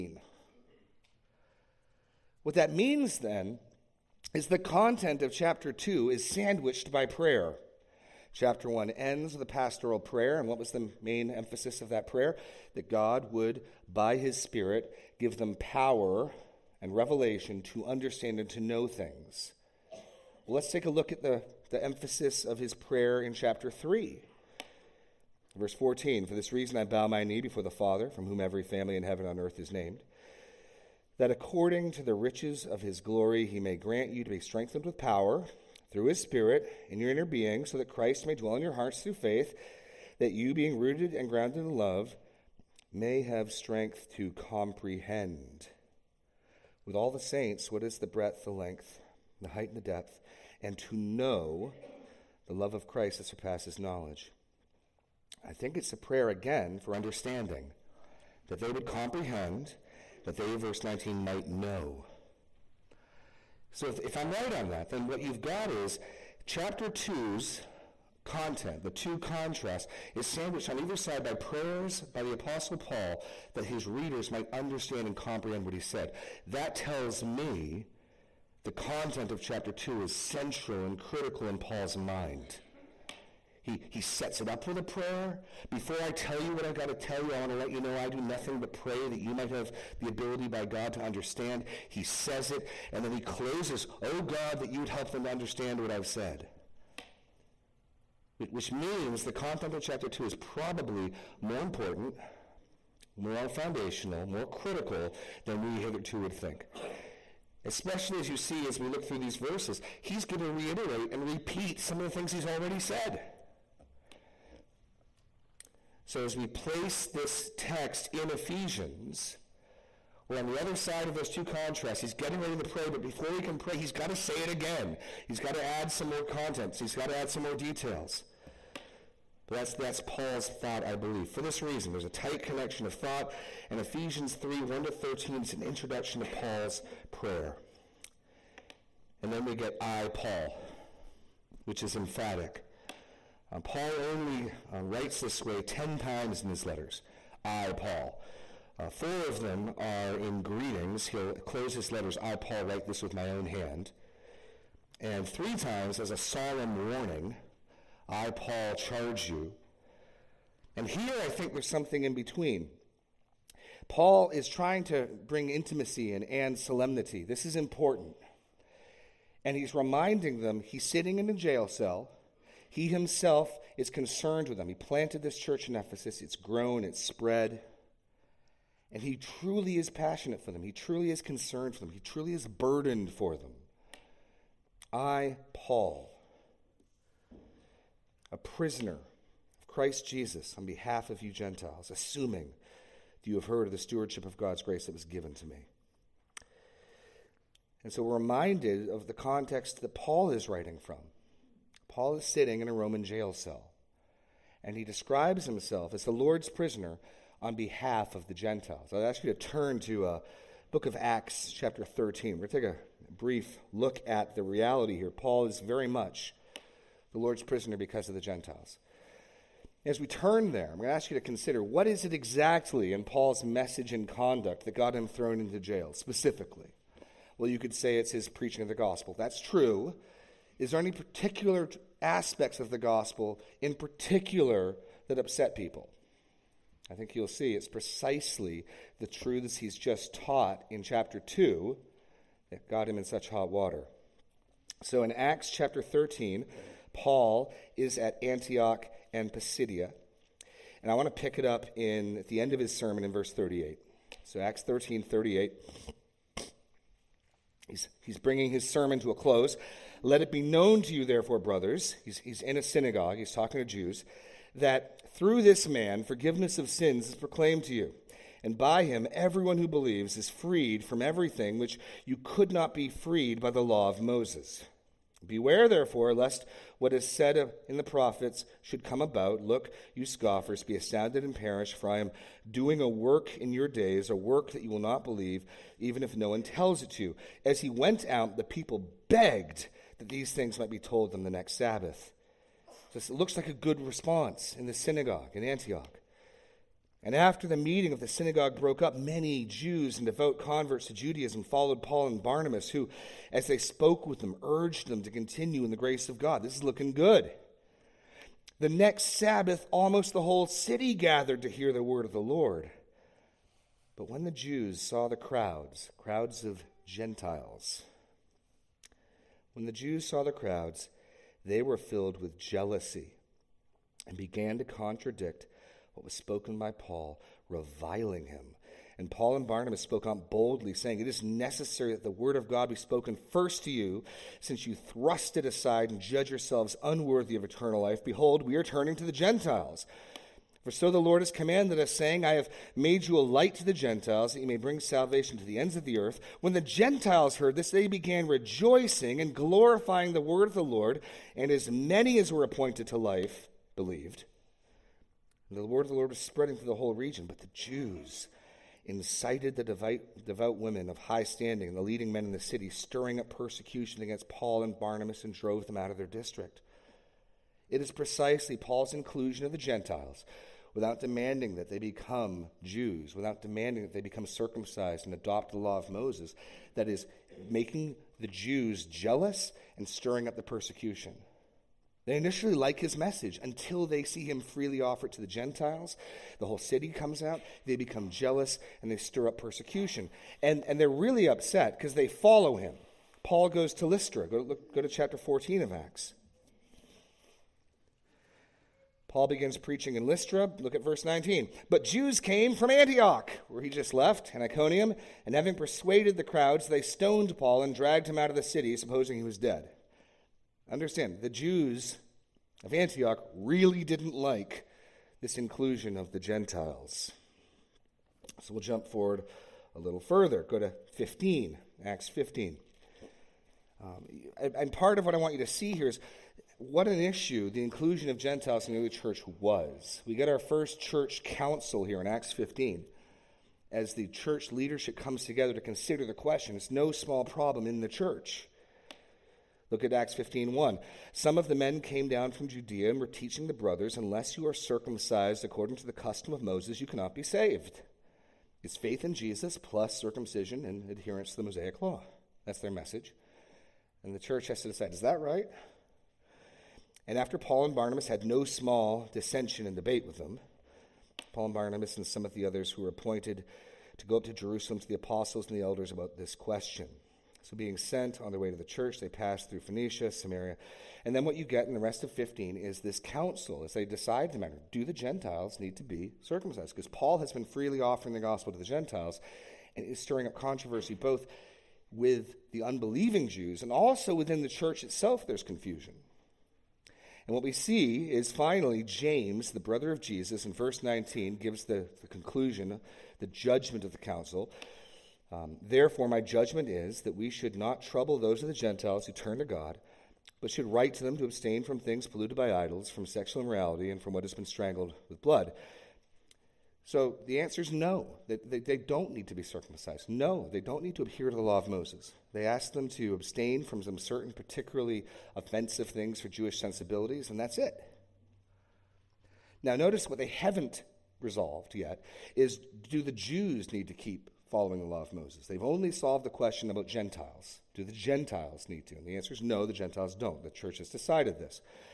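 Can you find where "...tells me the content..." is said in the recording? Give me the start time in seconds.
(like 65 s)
76 s.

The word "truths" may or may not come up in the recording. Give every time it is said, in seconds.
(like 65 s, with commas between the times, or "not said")
239 s.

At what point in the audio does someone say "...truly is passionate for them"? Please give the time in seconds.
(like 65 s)
179 s.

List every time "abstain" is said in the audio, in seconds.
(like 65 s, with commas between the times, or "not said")
501 s, 513 s.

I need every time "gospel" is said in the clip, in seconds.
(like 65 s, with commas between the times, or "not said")
228 s, 232 s, 478 s.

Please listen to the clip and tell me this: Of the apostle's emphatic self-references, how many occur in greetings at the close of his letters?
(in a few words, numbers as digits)
4.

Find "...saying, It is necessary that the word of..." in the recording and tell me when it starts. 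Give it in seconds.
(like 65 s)
330 s.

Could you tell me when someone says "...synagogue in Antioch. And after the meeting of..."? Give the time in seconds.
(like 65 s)
294 s.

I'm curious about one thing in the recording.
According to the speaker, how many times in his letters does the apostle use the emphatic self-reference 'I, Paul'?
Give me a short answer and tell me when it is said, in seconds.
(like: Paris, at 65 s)
10, at 145 s.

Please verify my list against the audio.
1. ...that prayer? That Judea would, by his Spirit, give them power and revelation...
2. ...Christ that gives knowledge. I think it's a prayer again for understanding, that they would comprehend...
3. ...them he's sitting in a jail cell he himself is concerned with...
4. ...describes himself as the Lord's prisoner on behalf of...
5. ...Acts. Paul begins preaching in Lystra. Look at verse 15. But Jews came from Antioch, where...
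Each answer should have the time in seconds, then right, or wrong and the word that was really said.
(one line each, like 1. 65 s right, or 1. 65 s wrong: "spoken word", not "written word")
1. 11 s wrong: "God", not "Judea"
2. 52 s wrong: "surpasses", not "gives"
3. 170 s right
4. 204 s right
5. 395 s wrong: "19", not "15".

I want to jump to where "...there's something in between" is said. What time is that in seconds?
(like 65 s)
161 s.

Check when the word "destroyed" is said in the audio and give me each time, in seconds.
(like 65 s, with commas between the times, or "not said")
not said.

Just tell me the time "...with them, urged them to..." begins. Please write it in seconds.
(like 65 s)
304 s.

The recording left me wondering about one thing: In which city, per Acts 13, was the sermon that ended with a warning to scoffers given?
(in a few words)
Antioch and Pisidia.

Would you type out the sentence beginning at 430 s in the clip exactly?
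We get our first church council here in Acts 15 as the church leadership comes together to consider the question.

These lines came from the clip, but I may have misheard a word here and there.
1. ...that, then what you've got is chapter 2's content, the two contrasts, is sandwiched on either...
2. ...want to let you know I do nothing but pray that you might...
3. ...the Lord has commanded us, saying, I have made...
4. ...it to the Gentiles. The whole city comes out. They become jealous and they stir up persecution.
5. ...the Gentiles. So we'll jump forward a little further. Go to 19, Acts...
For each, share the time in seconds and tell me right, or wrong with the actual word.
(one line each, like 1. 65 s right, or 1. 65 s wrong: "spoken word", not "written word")
1. 64 s right
2. 87 s right
3. 340 s right
4. 385 s right
5. 416 s wrong: "15", not "19".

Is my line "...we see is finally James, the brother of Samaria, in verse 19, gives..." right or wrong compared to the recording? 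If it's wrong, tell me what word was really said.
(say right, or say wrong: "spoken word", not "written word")
wrong: "Jesus", not "Samaria".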